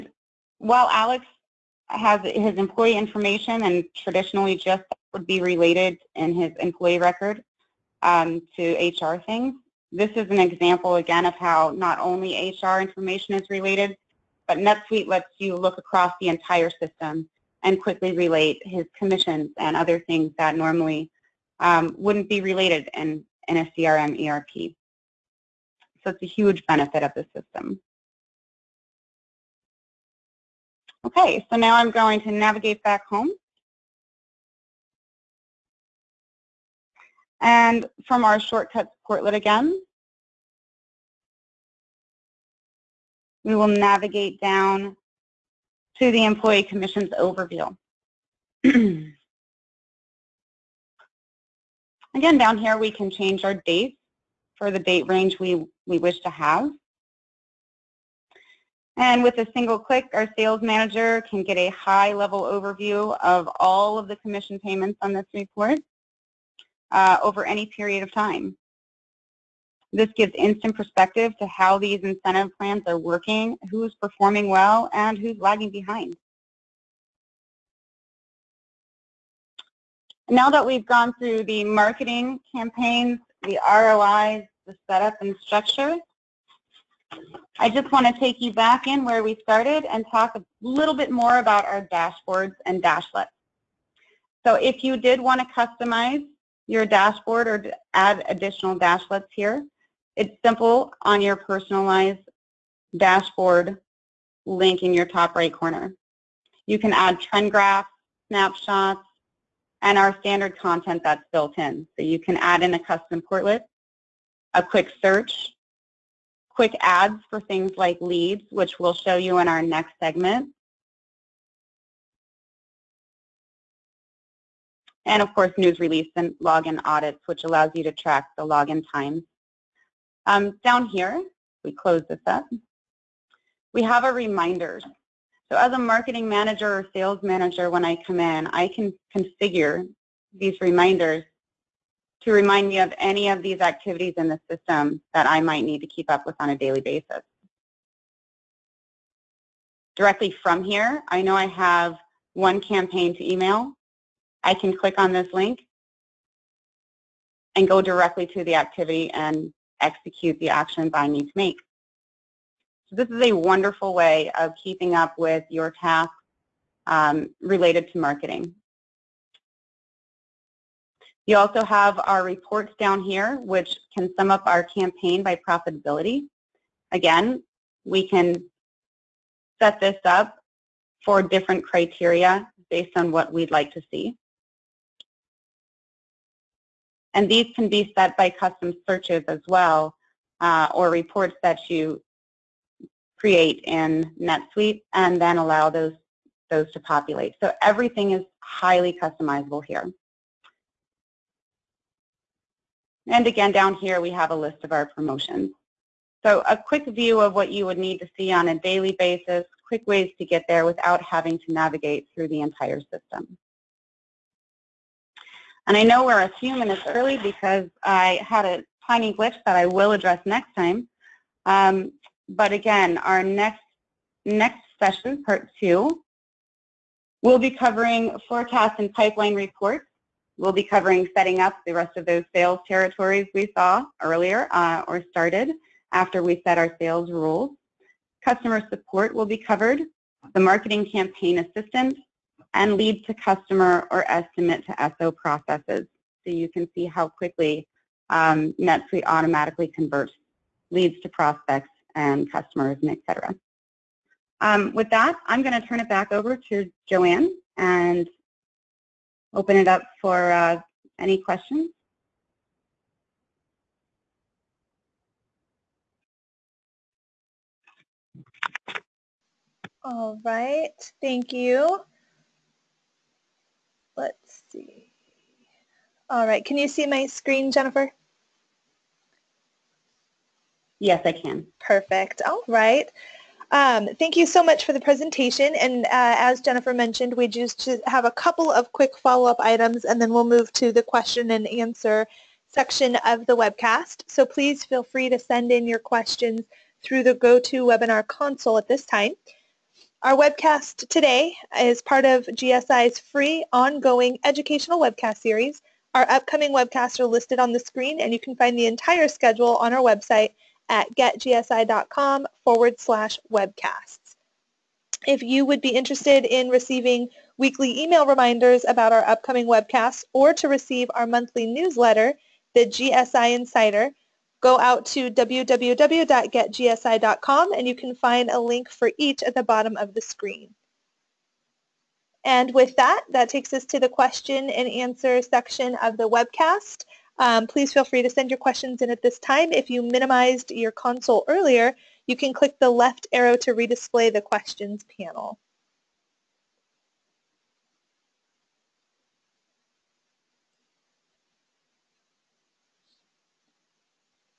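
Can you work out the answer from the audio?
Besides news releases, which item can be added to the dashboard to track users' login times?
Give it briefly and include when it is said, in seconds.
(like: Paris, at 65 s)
login audits, at 126 s.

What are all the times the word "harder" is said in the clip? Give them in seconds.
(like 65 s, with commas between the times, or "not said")
not said.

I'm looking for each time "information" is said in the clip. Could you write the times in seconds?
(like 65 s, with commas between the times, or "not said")
2 s, 12 s.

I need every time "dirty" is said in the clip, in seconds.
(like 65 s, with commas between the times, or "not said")
not said.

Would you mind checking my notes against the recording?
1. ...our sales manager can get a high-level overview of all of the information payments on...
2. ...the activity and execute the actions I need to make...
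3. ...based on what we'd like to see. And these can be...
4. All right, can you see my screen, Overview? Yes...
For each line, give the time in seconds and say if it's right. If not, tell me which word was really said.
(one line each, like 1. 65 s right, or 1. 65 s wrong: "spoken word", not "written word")
1. 60 s wrong: "commission", not "information"
2. 158 s right
3. 182 s right
4. 276 s wrong: "Jennifer", not "Overview".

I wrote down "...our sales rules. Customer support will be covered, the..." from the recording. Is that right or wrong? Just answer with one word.
right.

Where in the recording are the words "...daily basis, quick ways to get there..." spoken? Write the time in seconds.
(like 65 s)
208 s.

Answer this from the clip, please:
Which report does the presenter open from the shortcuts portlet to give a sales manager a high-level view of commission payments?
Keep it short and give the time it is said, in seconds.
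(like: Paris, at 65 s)
Employee Commissions Overview, at 46 s.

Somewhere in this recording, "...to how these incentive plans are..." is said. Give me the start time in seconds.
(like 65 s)
71 s.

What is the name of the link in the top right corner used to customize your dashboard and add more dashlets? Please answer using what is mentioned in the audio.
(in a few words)
personalized dashboard.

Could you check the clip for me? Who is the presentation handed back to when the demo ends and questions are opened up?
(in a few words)
Joanne.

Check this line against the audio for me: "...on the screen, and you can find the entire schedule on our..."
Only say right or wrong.
right.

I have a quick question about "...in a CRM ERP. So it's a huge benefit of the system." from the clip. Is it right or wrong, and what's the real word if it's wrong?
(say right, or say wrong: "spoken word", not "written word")
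right.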